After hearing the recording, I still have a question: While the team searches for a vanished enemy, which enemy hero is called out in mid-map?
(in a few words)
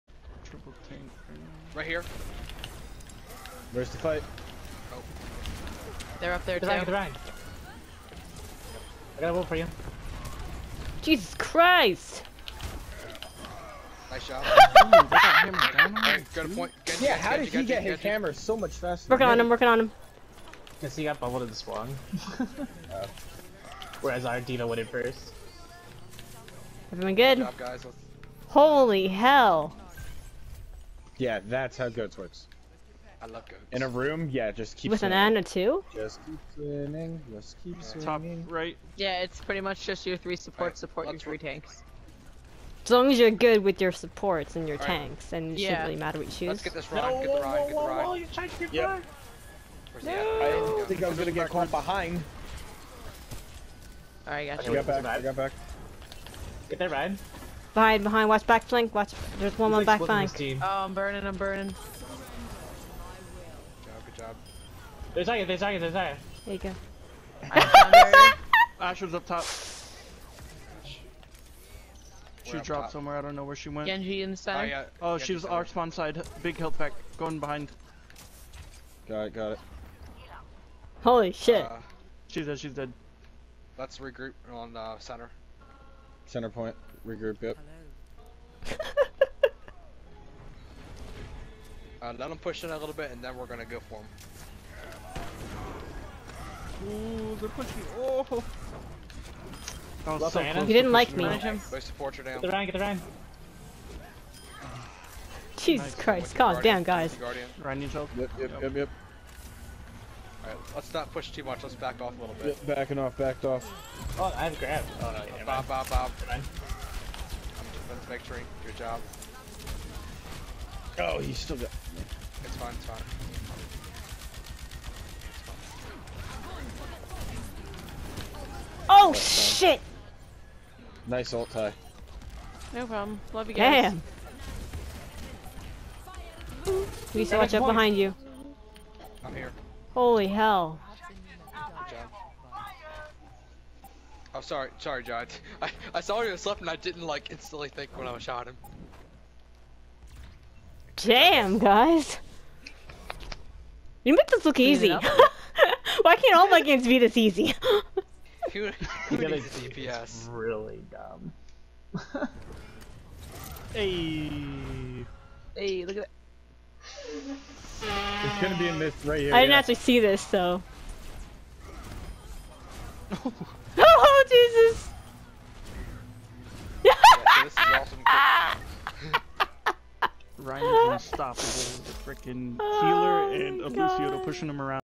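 Genji.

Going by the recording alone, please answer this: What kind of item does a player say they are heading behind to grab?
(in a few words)
Big health pack.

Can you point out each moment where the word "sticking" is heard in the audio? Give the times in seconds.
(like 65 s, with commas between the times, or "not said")
not said.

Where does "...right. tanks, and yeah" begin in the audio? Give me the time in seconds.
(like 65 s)
44 s.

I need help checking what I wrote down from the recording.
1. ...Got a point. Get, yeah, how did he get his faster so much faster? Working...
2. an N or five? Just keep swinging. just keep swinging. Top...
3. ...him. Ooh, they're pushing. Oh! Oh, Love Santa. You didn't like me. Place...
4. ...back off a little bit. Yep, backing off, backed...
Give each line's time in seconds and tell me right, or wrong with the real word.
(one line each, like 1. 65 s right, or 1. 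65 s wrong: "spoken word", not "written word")
1. 14 s wrong: "hammer", not "faster"
2. 35 s wrong: "two", not "five"
3. 94 s right
4. 111 s right.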